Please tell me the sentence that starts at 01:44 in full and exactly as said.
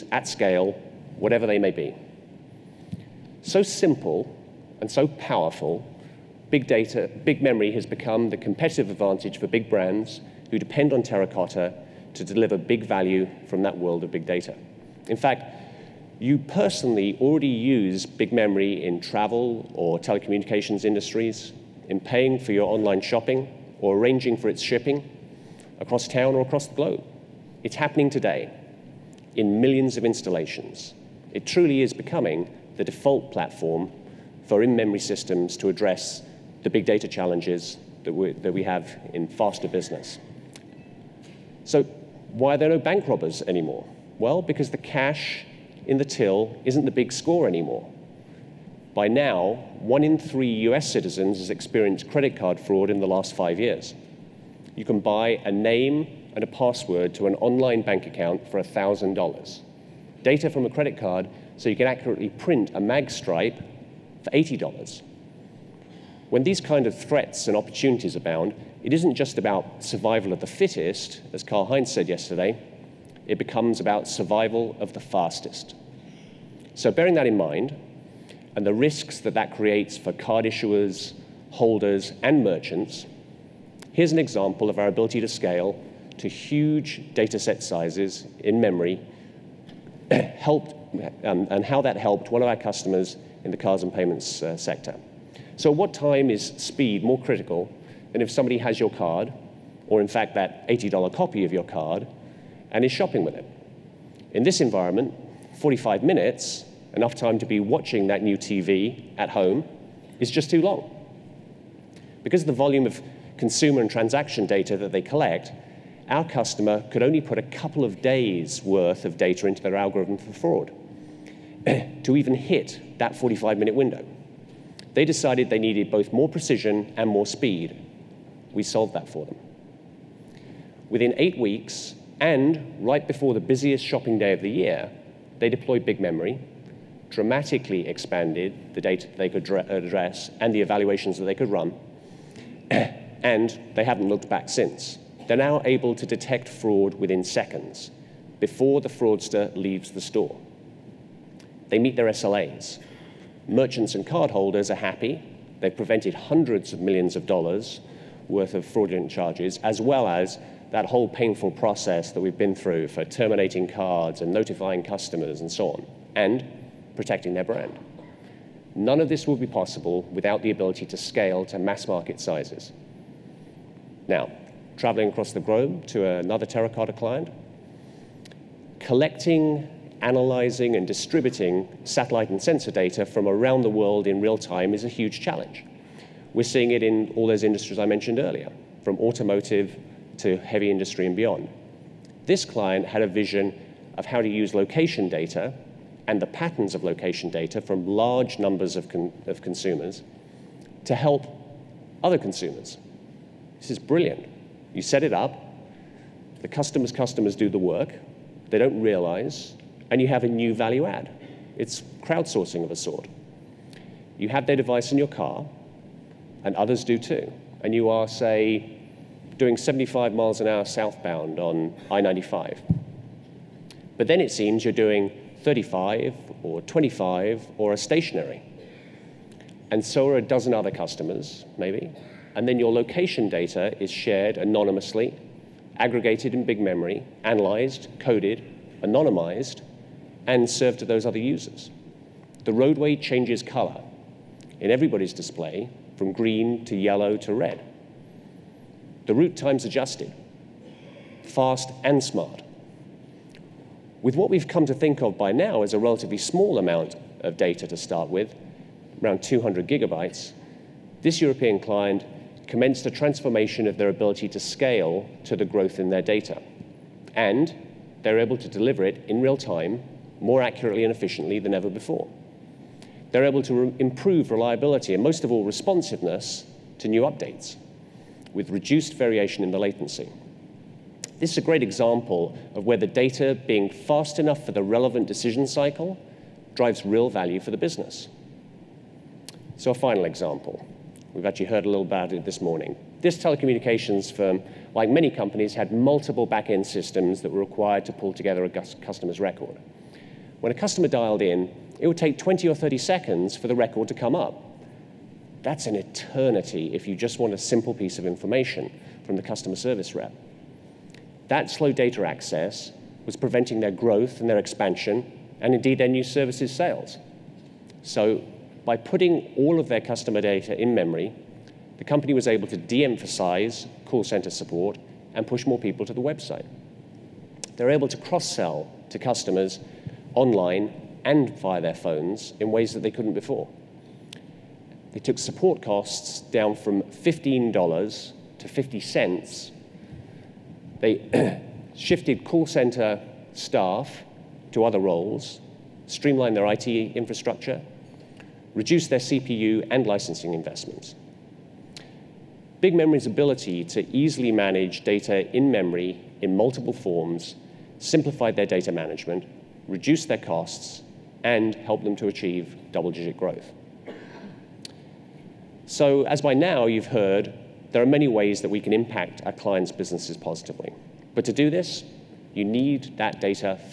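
In this environment, 45 minutes, enough time to be watching that new TV at home, is just too long.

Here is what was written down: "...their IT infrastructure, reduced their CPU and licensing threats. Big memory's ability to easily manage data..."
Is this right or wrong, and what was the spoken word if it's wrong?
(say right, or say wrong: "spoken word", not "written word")
wrong: "investments", not "threats".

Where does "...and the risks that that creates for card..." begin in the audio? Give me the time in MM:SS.
01:18.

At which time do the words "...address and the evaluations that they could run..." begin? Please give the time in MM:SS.
02:19.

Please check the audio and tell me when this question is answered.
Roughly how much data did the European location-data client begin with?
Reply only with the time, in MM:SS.
04:19.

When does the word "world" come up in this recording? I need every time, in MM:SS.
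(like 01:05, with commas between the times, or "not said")
00:13, 03:03.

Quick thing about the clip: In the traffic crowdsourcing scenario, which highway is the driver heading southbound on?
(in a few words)
I-95.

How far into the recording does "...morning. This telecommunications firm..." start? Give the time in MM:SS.
04:52.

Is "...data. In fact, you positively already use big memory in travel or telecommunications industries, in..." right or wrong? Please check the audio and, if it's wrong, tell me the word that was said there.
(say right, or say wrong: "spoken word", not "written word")
wrong: "personally", not "positively".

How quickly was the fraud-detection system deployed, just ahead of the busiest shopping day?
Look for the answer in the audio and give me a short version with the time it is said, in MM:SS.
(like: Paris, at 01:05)
Eight weeks, at 02:11.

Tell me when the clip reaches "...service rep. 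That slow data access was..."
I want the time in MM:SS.
05:09.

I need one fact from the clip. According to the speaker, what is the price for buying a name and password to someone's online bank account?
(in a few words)
$1,000.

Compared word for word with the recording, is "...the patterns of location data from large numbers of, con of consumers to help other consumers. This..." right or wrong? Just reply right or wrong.
right.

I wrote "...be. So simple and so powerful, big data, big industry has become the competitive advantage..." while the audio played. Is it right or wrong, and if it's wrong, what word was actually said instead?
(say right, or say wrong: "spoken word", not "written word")
wrong: "memory", not "industry".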